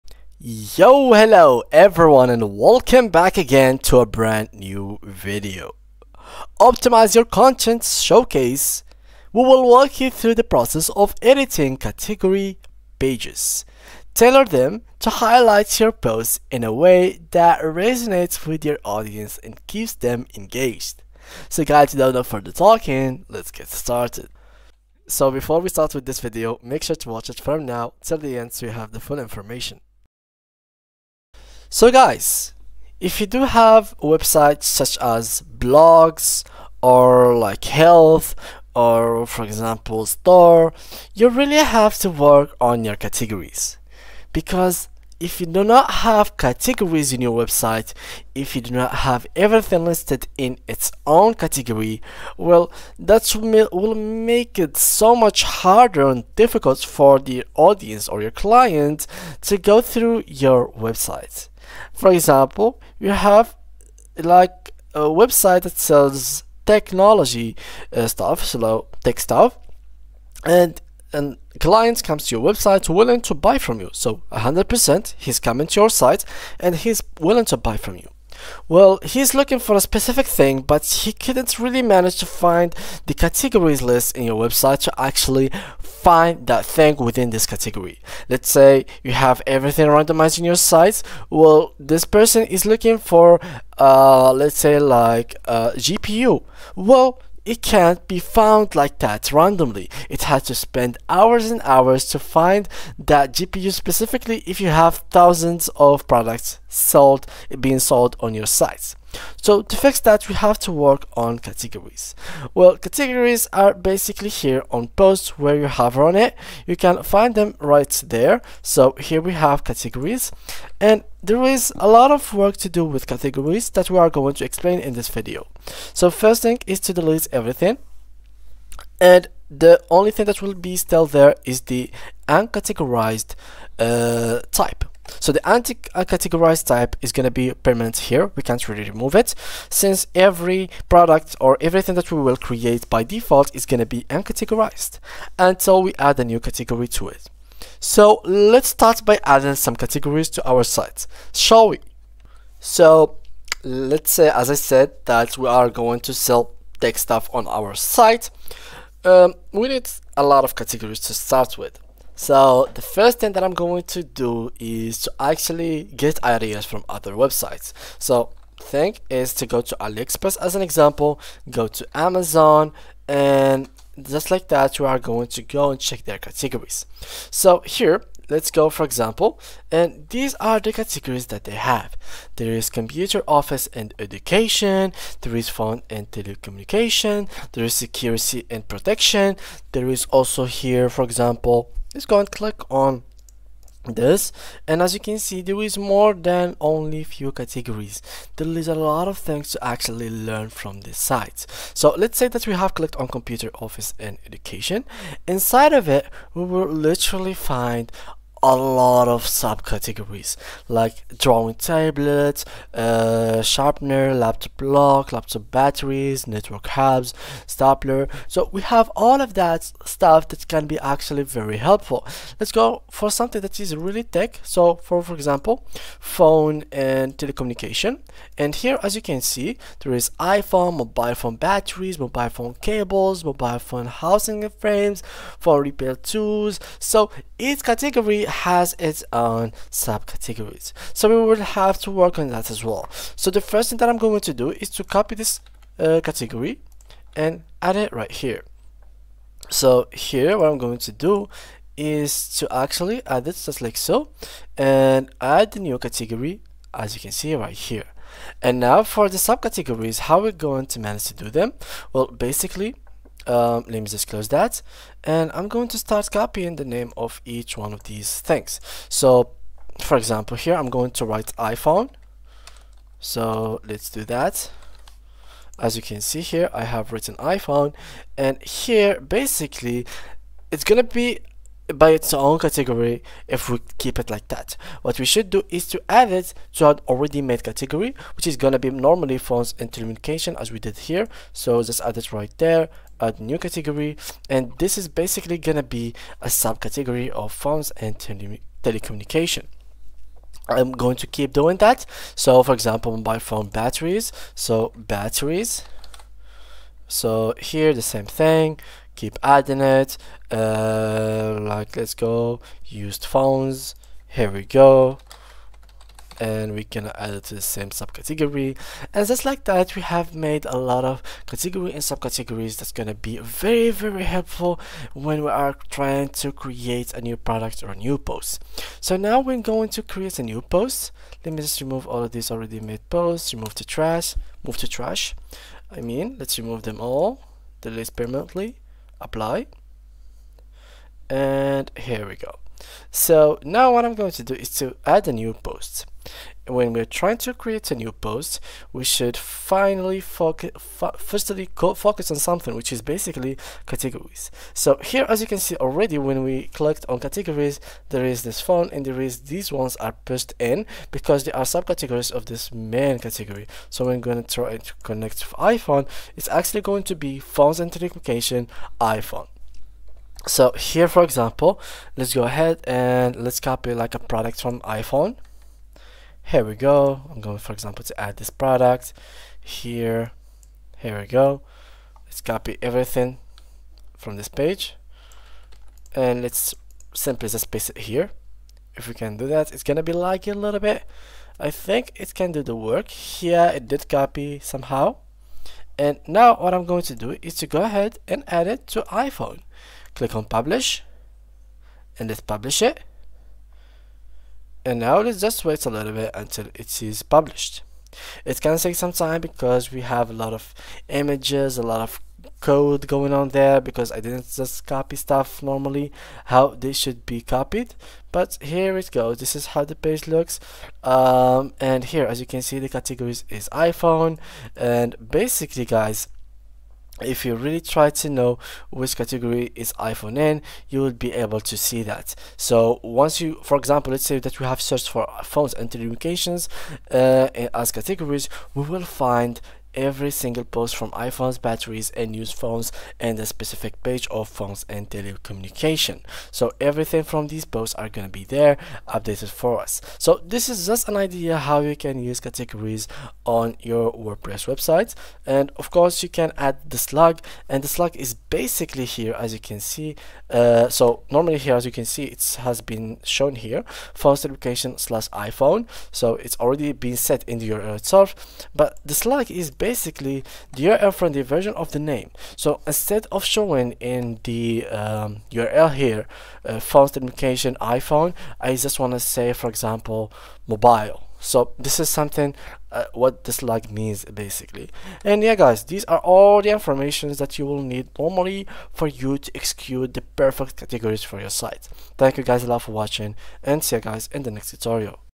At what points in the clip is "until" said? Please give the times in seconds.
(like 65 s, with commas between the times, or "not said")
145 s, 406 s.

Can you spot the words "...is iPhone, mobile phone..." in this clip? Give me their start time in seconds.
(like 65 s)
229 s.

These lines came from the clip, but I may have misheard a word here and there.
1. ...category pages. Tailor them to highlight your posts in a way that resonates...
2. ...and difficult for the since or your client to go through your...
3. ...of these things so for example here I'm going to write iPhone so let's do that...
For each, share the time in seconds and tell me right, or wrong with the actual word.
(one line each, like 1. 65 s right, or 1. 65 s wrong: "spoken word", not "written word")
1. 11 s right
2. 56 s wrong: "audience", not "since"
3. 267 s right.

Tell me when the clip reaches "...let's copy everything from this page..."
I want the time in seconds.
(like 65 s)
382 s.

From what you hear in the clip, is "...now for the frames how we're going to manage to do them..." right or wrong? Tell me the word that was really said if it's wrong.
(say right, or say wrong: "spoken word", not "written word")
wrong: "subcategories", not "frames".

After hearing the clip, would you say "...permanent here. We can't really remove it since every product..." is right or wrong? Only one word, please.
right.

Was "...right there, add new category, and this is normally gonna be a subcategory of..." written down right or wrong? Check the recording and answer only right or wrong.
wrong.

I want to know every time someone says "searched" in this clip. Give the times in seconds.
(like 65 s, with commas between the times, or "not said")
434 s.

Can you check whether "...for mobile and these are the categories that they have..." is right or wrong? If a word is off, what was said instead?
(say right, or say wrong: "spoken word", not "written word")
wrong: "example", not "mobile".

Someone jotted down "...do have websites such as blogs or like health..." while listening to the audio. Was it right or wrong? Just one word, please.
right.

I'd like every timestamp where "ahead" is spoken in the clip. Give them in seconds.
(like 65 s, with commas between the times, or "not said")
372 s, 397 s.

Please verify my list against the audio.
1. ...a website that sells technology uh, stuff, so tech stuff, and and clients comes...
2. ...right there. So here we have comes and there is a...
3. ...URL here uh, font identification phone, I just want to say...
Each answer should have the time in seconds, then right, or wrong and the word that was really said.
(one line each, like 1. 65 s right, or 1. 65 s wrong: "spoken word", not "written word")
1. 64 s right
2. 117 s wrong: "categories", not "comes"
3. 475 s wrong: "iPhone", not "phone".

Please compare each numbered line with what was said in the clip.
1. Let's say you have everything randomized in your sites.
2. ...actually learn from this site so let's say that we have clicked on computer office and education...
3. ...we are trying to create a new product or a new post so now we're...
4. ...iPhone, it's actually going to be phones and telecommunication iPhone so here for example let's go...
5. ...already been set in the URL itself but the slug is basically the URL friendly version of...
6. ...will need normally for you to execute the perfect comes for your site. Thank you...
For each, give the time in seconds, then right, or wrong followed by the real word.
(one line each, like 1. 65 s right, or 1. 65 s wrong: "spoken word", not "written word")
1. 88 s right
2. 199 s right
3. 325 s right
4. 365 s right
5. 466 s right
6. 487 s wrong: "categories", not "comes".